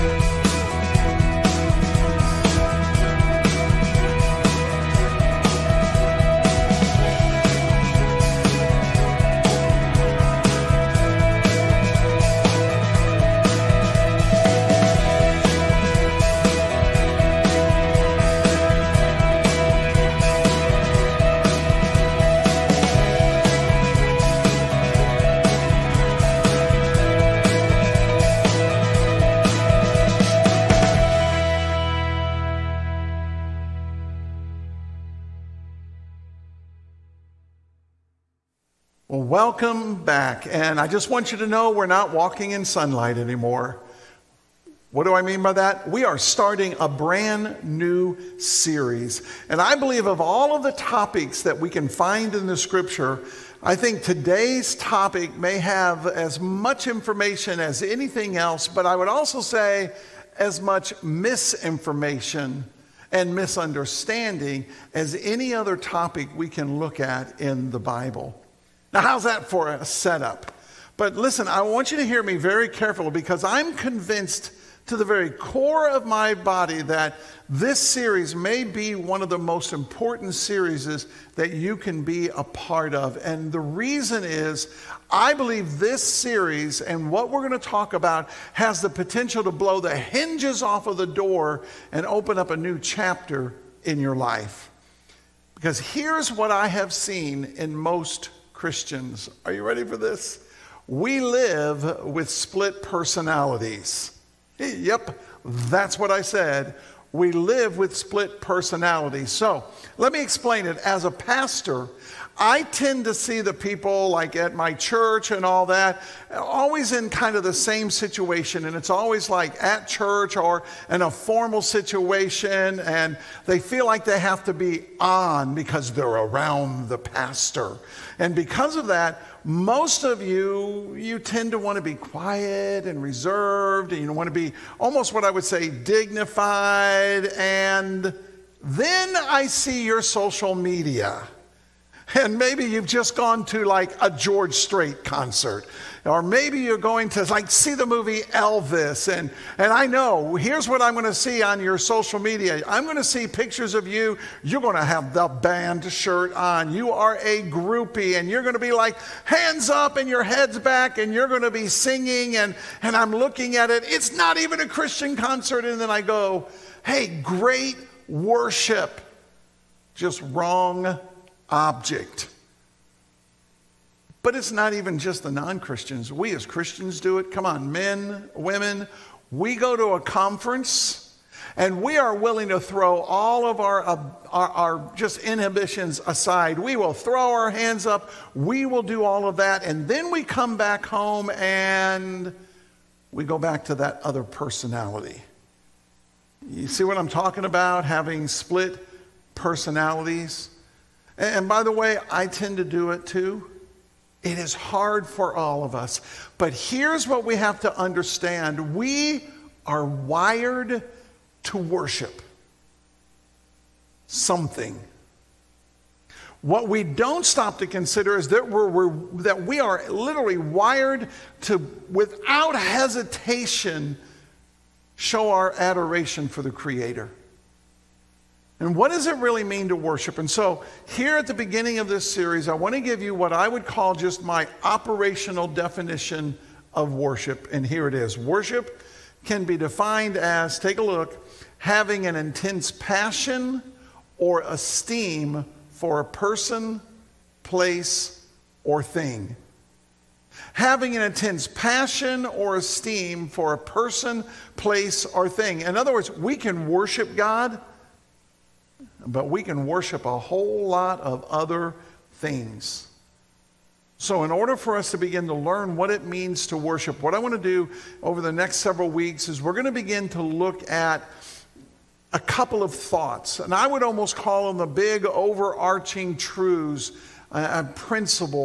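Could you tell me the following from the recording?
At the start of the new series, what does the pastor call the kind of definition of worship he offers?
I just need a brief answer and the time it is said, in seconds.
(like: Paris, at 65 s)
Operational definition, at 234 s.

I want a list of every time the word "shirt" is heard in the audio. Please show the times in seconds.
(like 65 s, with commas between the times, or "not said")
155 s.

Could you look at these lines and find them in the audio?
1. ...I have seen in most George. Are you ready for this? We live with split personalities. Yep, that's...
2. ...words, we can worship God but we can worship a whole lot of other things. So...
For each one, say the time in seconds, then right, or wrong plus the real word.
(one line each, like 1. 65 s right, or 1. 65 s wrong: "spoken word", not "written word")
1. 96 s wrong: "Christians", not "George"
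2. 255 s right.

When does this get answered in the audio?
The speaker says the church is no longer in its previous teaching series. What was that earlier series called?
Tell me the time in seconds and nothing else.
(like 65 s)
42 s.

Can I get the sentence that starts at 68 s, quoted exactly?
Now, how's that for a setup?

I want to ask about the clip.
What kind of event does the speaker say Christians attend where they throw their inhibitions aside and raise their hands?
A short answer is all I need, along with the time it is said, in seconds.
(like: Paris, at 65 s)
A conference, at 180 s.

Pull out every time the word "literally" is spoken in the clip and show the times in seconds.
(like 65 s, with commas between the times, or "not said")
219 s.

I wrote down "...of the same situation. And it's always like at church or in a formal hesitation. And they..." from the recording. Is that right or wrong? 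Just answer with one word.
wrong.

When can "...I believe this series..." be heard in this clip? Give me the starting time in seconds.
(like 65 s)
85 s.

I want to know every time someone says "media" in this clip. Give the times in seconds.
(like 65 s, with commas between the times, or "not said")
140 s, 152 s.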